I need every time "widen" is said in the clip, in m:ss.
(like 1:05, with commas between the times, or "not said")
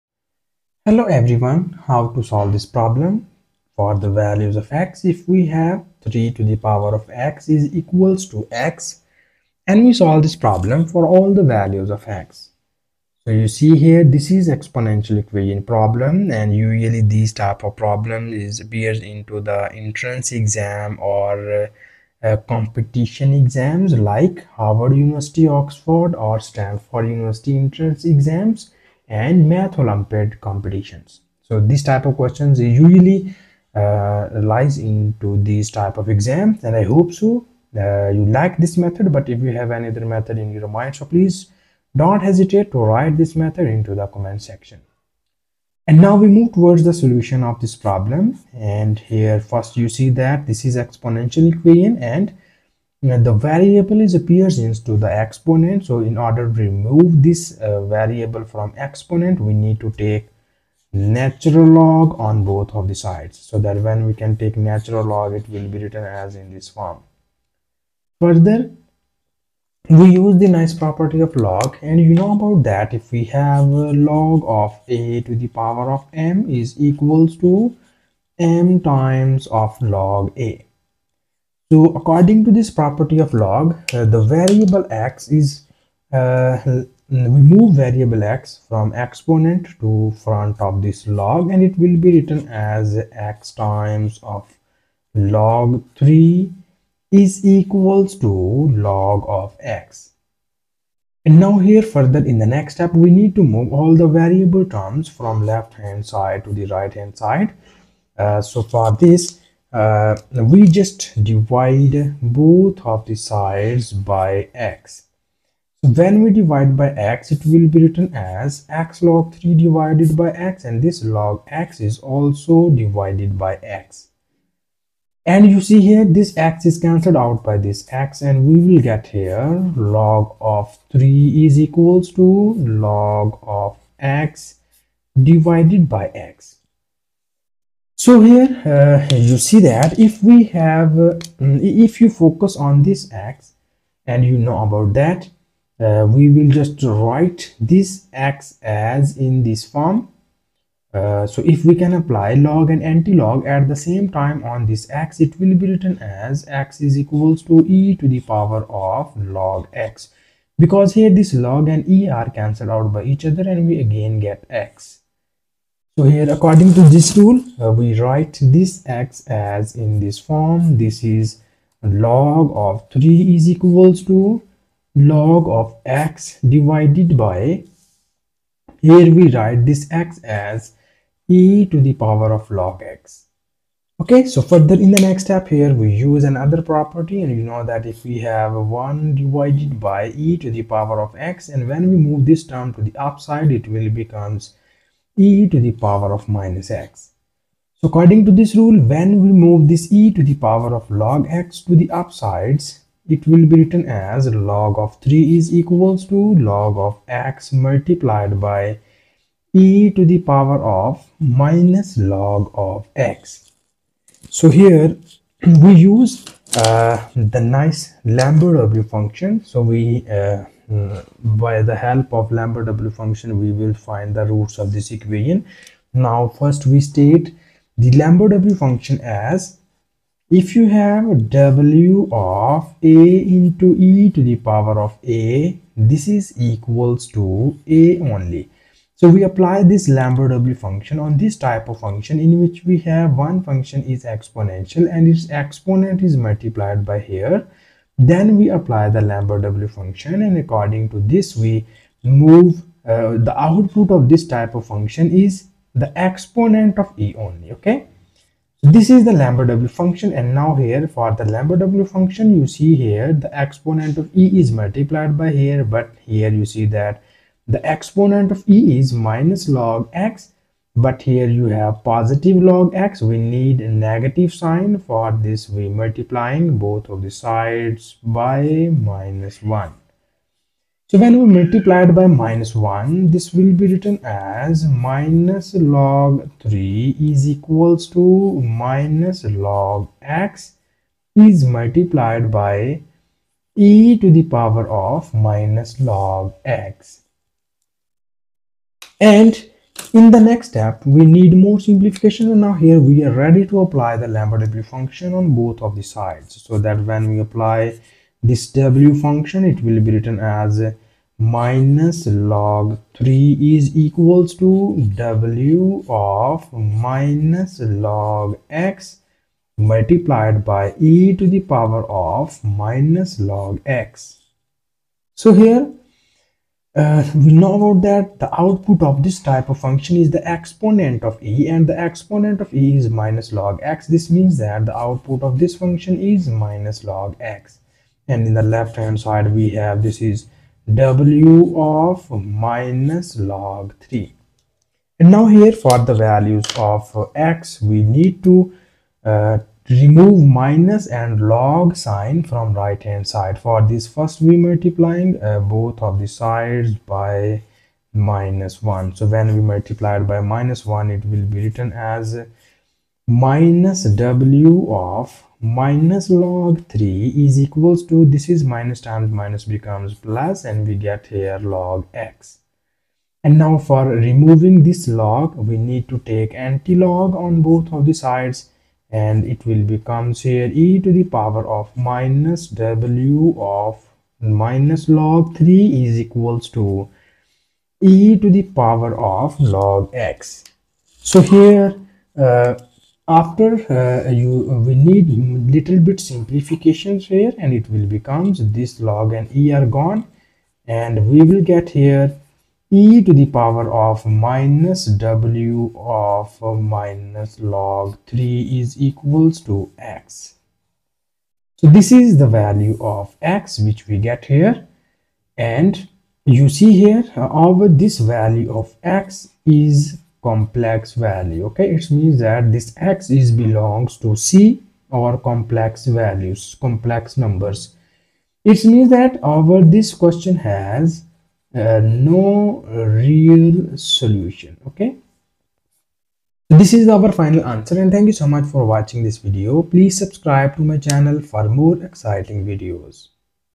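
not said.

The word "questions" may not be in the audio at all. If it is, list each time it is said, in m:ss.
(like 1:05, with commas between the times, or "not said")
0:32, 7:09.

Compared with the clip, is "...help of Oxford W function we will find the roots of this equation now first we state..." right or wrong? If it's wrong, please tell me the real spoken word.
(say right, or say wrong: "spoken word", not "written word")
wrong: "Lambert", not "Oxford".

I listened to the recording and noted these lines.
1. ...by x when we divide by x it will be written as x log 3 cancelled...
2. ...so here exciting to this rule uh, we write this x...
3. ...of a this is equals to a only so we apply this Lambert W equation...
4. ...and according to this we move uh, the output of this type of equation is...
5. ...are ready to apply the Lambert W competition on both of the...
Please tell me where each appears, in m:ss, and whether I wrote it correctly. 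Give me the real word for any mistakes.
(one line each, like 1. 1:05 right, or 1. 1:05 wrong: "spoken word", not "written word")
1. 1:53 wrong: "divided", not "cancelled"
2. 2:46 wrong: "according", not "exciting"
3. 3:54 wrong: "function", not "equation"
4. 4:10 wrong: "function", not "equation"
5. 5:03 wrong: "function", not "competition".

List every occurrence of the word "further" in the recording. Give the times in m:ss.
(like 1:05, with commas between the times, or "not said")
1:08, 1:41, 3:04.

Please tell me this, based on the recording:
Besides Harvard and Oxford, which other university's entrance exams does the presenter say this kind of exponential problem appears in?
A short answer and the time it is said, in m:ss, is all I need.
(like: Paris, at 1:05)
Stanford University, at 0:26.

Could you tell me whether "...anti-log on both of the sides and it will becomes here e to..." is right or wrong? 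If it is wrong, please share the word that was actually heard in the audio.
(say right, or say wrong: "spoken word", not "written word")
right.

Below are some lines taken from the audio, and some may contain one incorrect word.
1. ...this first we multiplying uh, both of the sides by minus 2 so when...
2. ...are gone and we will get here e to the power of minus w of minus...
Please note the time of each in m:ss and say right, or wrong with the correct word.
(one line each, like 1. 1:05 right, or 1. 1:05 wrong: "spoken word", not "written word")
1. 5:53 wrong: "1", not "2"
2. 6:39 right.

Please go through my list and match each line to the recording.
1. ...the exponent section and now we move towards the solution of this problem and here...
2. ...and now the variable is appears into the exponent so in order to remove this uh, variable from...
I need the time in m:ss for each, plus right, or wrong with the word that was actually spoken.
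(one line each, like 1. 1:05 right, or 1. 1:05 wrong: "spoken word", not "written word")
1. 0:43 wrong: "comment", not "exponent"
2. 0:52 right.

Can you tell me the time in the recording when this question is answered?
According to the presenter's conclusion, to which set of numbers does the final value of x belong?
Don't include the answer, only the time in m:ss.
7:06.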